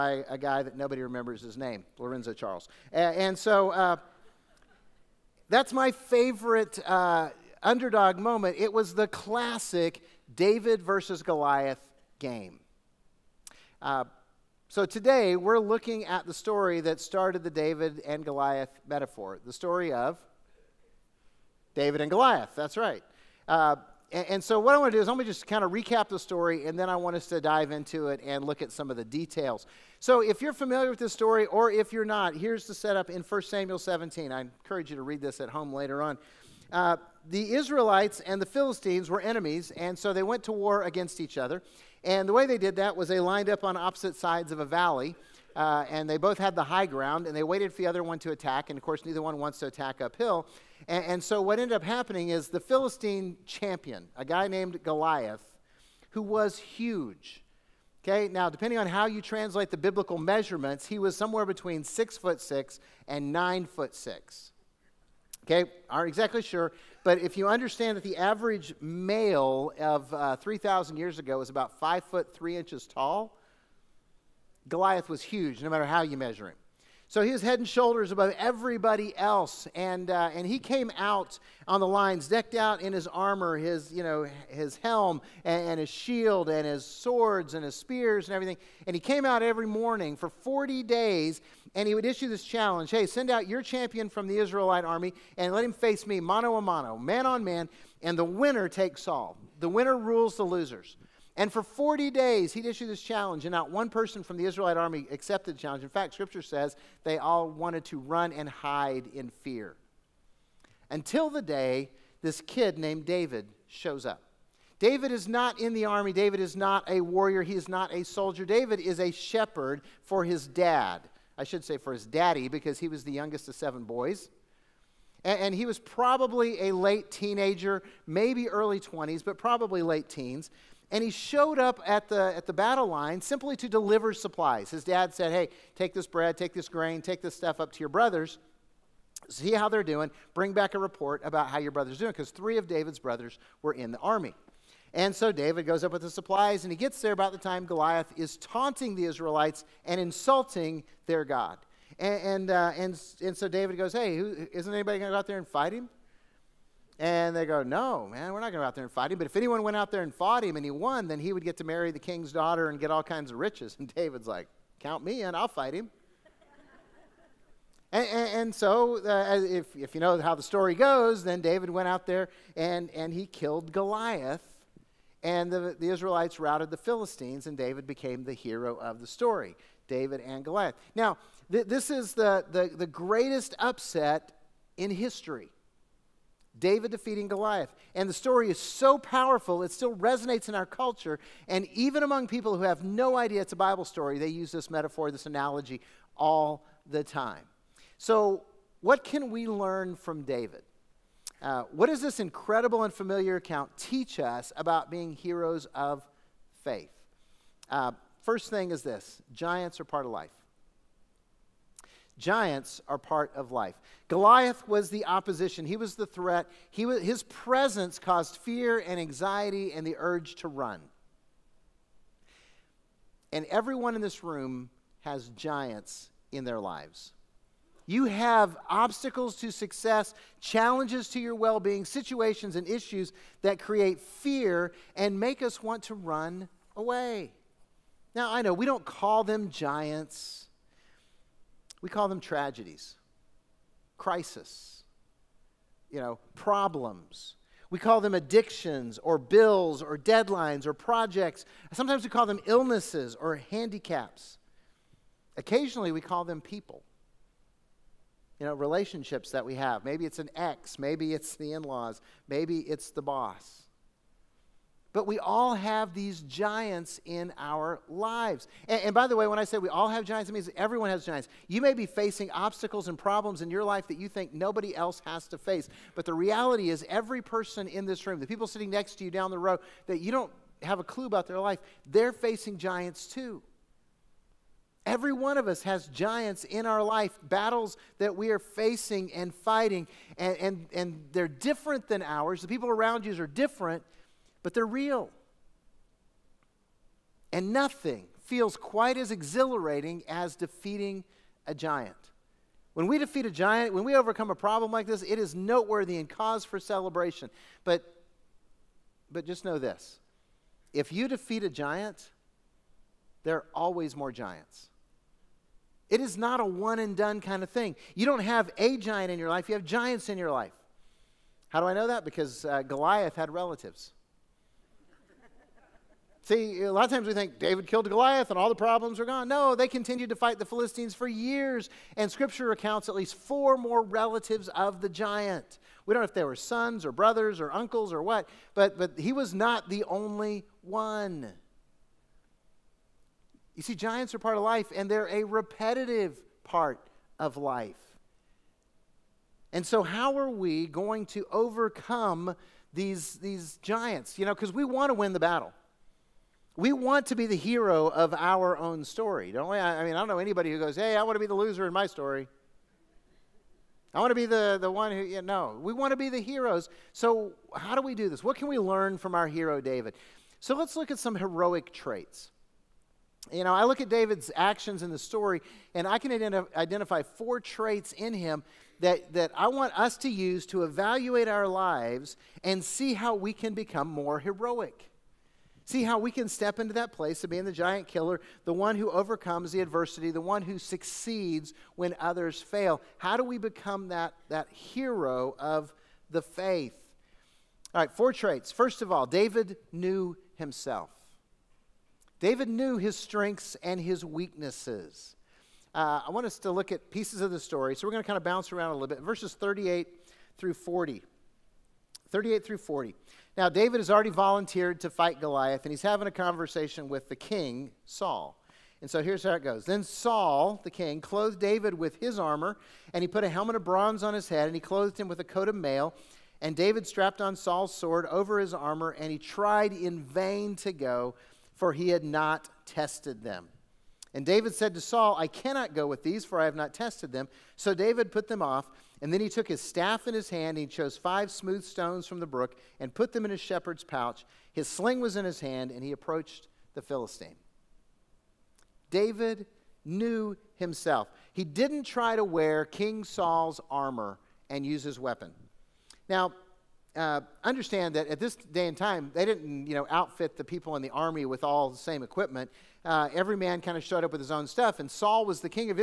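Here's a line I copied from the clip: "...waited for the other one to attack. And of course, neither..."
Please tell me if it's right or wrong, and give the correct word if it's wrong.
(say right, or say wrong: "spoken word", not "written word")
right.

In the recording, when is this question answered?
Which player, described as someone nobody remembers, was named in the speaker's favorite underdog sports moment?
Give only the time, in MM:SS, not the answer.
00:01.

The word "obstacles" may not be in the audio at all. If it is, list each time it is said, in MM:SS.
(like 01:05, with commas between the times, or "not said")
03:48, 04:32.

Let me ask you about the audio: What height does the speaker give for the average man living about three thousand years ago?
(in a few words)
5 foot 3 inches.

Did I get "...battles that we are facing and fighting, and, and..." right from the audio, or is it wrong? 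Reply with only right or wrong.
right.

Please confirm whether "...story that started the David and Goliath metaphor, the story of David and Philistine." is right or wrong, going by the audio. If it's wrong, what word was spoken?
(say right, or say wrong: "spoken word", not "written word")
wrong: "Goliath", not "Philistine".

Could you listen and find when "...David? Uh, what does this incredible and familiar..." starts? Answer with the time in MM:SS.
03:20.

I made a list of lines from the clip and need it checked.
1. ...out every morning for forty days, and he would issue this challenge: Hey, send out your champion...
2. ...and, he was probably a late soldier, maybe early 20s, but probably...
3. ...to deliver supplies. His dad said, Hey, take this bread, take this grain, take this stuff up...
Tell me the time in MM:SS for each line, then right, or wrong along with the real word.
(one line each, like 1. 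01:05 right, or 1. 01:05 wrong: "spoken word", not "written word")
1. 01:29 right
2. 02:05 wrong: "teenager", not "soldier"
3. 02:13 right.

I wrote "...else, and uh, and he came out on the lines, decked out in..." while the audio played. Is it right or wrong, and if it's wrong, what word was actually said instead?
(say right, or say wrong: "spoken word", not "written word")
right.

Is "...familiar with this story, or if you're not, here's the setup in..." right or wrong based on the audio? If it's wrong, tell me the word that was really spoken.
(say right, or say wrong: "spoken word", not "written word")
right.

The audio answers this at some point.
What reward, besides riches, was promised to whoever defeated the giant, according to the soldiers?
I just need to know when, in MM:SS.
02:41.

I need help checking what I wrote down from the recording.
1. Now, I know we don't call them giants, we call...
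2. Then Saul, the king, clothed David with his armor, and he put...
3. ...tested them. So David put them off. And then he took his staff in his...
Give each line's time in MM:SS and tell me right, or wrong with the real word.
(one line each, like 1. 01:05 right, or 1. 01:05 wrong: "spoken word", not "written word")
1. 03:58 right
2. 06:59 right
3. 07:16 right.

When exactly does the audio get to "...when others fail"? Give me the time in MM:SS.
06:31.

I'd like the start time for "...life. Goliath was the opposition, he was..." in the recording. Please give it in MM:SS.
03:33.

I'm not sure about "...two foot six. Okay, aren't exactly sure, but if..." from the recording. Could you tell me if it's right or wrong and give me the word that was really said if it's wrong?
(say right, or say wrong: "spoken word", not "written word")
wrong: "nine", not "two".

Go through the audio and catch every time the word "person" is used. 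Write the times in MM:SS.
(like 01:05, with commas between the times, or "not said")
01:43, 04:37.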